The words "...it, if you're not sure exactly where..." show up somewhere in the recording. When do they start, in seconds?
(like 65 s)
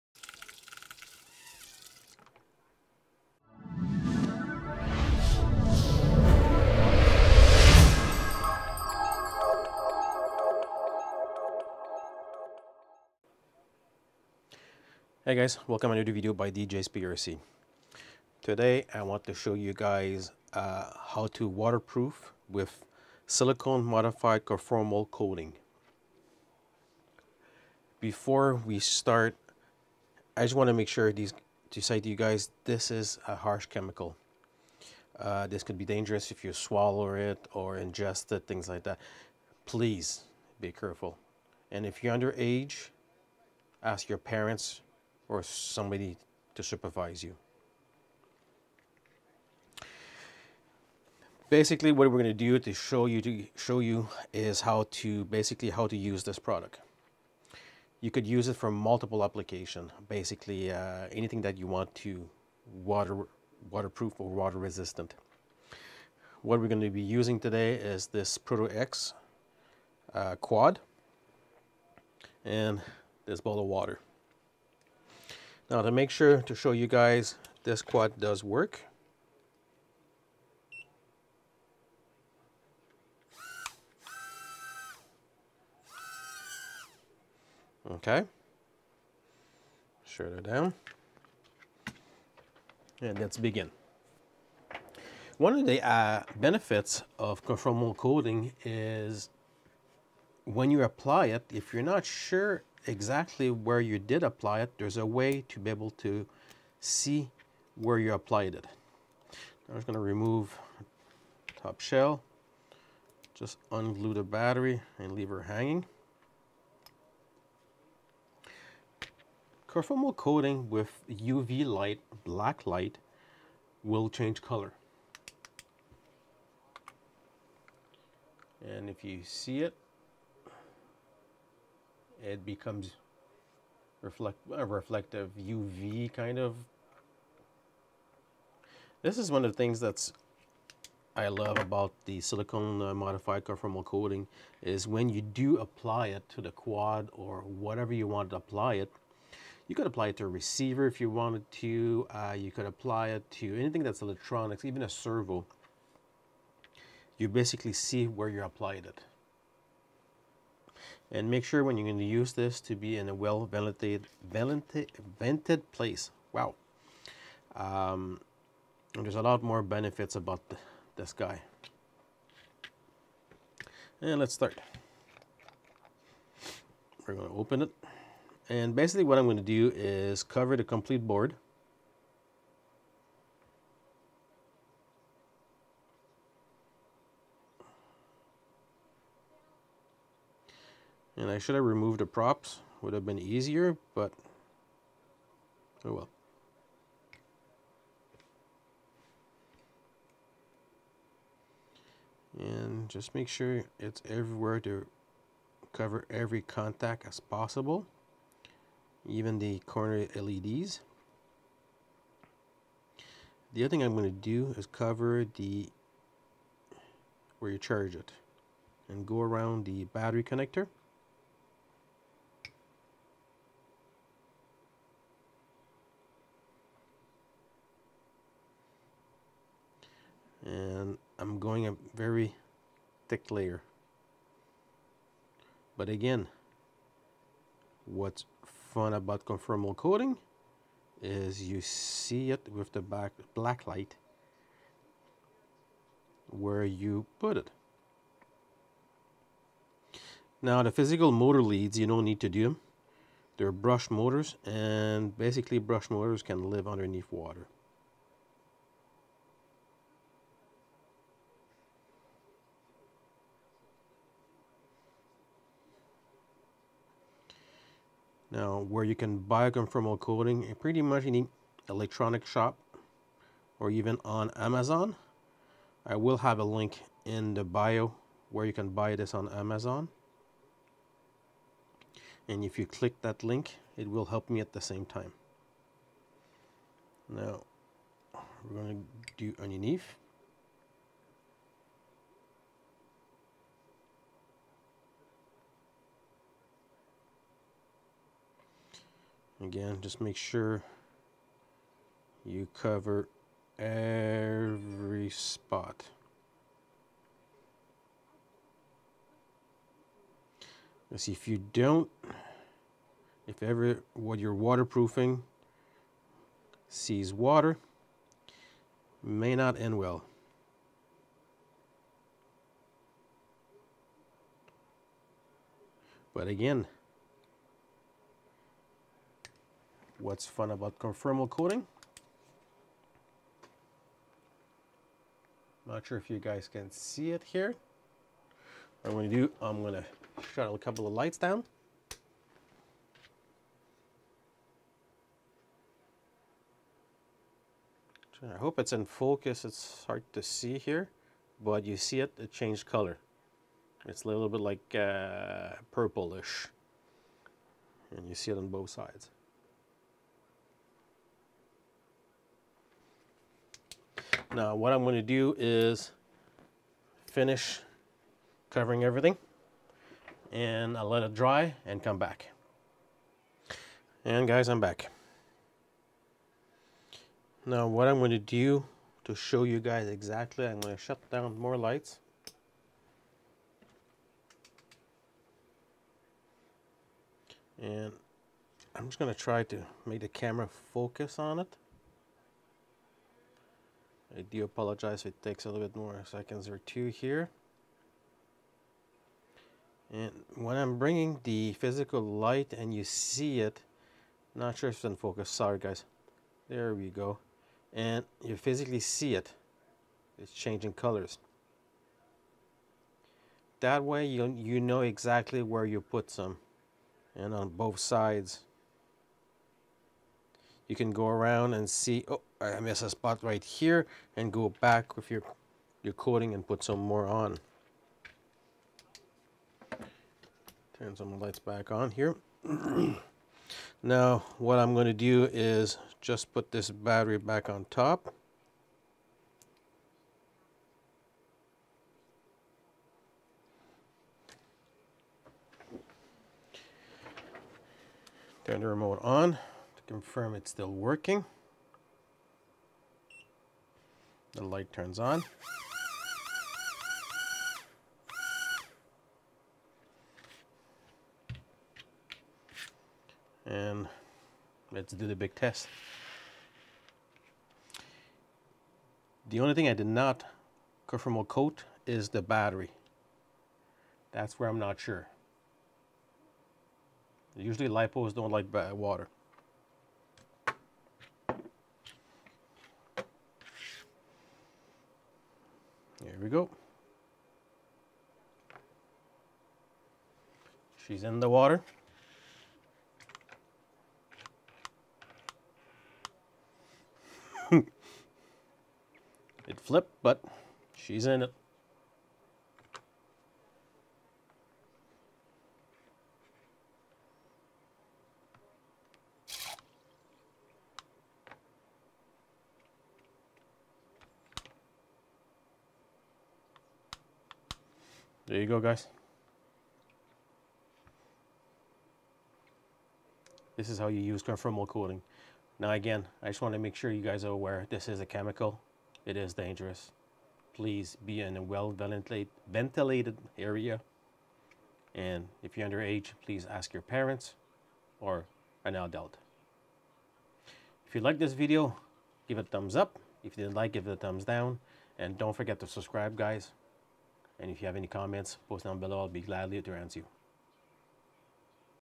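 101 s.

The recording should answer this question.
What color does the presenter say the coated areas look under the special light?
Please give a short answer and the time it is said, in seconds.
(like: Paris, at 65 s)
Purplish, at 355 s.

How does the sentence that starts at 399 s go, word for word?
And when I'm bringing the physical light and you see it, not sure if it's in focus, sorry guys.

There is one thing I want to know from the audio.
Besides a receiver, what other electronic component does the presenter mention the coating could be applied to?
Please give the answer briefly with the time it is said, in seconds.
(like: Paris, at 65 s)
A servo, at 154 s.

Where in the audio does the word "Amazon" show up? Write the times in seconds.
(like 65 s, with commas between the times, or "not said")
274 s, 279 s.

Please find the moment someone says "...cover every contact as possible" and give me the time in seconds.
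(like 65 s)
205 s.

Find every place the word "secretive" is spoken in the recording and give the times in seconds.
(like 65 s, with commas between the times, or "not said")
not said.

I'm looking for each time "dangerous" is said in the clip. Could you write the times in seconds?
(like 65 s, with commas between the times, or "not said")
35 s, 529 s.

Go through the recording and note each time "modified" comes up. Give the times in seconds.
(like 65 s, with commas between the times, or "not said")
23 s, 142 s.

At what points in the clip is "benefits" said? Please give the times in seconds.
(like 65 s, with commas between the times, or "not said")
96 s, 169 s.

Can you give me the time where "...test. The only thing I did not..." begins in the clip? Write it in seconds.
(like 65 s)
465 s.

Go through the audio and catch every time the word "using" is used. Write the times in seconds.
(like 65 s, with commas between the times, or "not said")
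67 s.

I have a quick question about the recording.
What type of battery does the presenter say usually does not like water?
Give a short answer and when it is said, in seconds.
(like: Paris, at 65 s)
Lipos, at 477 s.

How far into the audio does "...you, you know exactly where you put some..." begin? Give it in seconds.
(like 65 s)
414 s.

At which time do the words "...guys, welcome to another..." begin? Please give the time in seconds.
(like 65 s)
15 s.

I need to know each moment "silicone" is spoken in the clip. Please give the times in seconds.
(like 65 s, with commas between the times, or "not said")
23 s, 142 s.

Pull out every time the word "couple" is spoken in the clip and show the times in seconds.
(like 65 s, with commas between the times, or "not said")
340 s.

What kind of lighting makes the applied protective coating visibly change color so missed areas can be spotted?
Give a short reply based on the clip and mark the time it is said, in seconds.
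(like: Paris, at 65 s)
UV light, at 121 s.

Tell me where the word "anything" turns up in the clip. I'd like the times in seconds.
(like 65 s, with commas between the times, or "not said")
61 s, 153 s.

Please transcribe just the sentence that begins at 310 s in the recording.
Let's see if you don't, if ever what you're waterproofing sees water, may not end well.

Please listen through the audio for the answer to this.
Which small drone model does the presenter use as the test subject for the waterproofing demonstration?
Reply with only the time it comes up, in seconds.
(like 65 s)
68 s.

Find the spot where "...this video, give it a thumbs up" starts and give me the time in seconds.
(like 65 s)
541 s.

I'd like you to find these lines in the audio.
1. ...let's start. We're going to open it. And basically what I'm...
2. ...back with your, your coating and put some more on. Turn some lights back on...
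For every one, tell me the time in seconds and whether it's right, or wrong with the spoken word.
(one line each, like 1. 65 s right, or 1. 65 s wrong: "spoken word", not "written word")
1. 174 s right
2. 424 s right.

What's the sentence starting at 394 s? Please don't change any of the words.
I do apologize it takes a little bit more seconds or two here.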